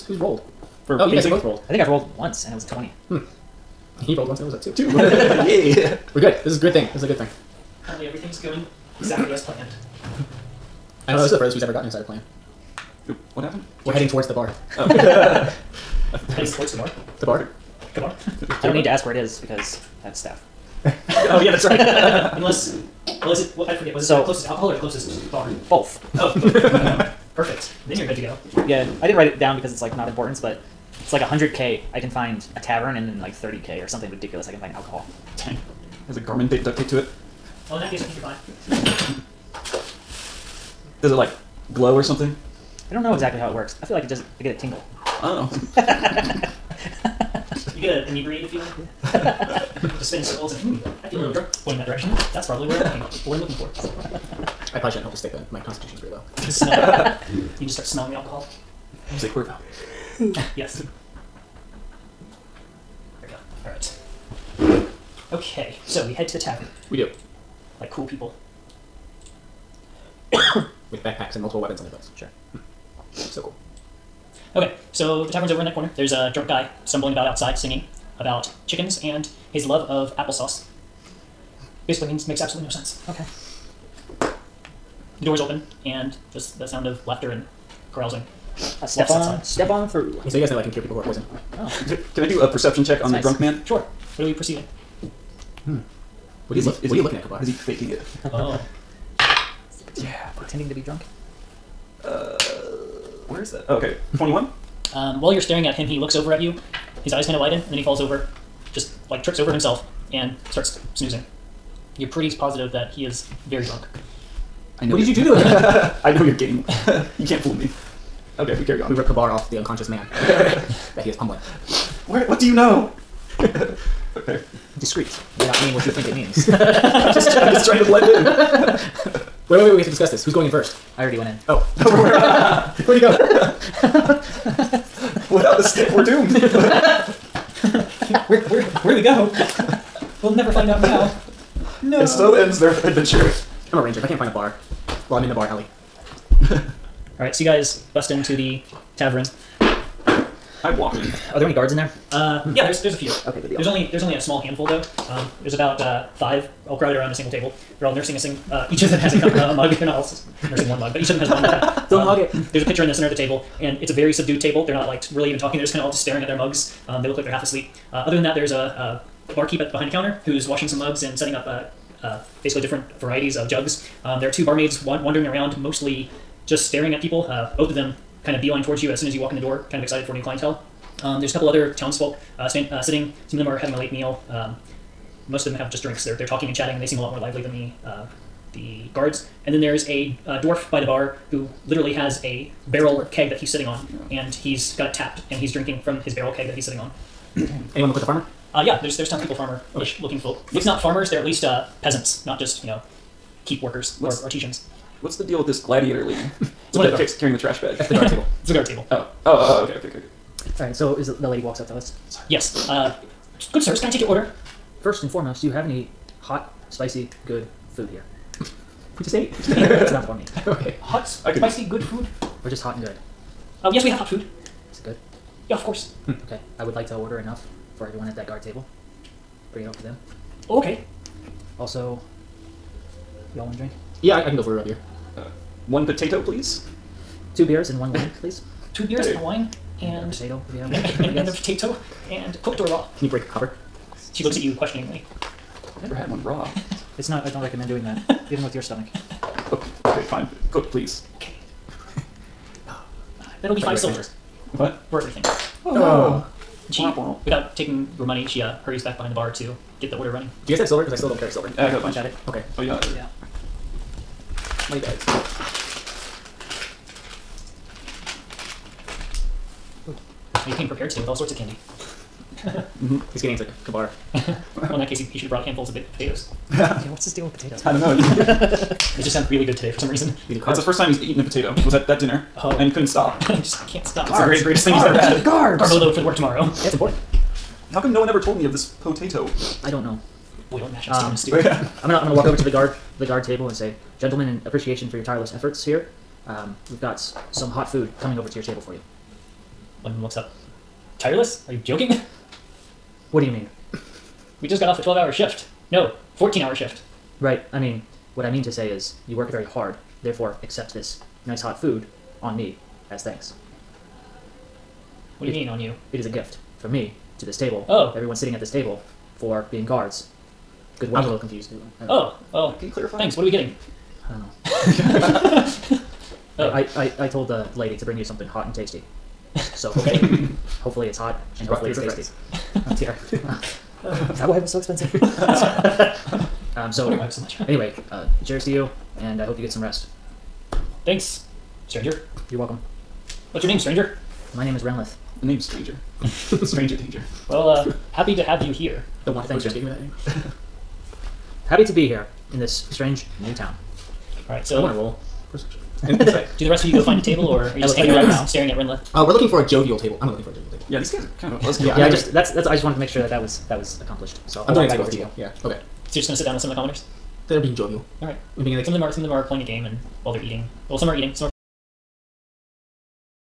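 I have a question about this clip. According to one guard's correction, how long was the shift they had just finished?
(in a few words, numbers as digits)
14 hours.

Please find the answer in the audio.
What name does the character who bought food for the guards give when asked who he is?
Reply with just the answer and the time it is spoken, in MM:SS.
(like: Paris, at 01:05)
Renlith, at 05:44.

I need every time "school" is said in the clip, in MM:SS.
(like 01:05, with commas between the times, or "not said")
not said.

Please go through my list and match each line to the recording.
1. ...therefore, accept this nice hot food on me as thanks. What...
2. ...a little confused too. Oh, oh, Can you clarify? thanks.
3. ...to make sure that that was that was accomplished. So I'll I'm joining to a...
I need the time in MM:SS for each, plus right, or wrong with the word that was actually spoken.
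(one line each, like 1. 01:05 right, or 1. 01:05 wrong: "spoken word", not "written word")
1. 05:10 right
2. 05:21 right
3. 06:02 right.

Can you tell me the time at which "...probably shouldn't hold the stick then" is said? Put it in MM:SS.
00:54.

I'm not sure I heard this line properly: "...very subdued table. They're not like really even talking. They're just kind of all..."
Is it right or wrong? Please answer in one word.
right.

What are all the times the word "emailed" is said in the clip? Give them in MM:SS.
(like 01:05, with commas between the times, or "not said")
not said.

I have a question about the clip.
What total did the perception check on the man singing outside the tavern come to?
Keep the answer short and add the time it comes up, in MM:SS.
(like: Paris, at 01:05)
21, at 01:44.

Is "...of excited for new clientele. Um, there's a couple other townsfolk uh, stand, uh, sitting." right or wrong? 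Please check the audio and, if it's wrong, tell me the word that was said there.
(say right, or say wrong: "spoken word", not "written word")
right.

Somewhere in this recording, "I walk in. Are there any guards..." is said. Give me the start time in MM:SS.
02:29.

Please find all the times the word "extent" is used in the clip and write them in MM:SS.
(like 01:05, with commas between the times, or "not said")
not said.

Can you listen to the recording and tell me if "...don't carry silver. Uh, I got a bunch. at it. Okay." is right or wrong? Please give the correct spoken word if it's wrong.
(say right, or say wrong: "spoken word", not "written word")
right.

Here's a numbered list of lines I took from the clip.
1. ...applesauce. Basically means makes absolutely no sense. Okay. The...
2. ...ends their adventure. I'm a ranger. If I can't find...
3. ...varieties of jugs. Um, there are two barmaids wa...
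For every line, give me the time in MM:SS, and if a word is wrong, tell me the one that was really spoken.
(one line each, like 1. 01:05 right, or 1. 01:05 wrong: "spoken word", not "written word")
1. 01:20 right
2. 02:22 right
3. 02:52 right.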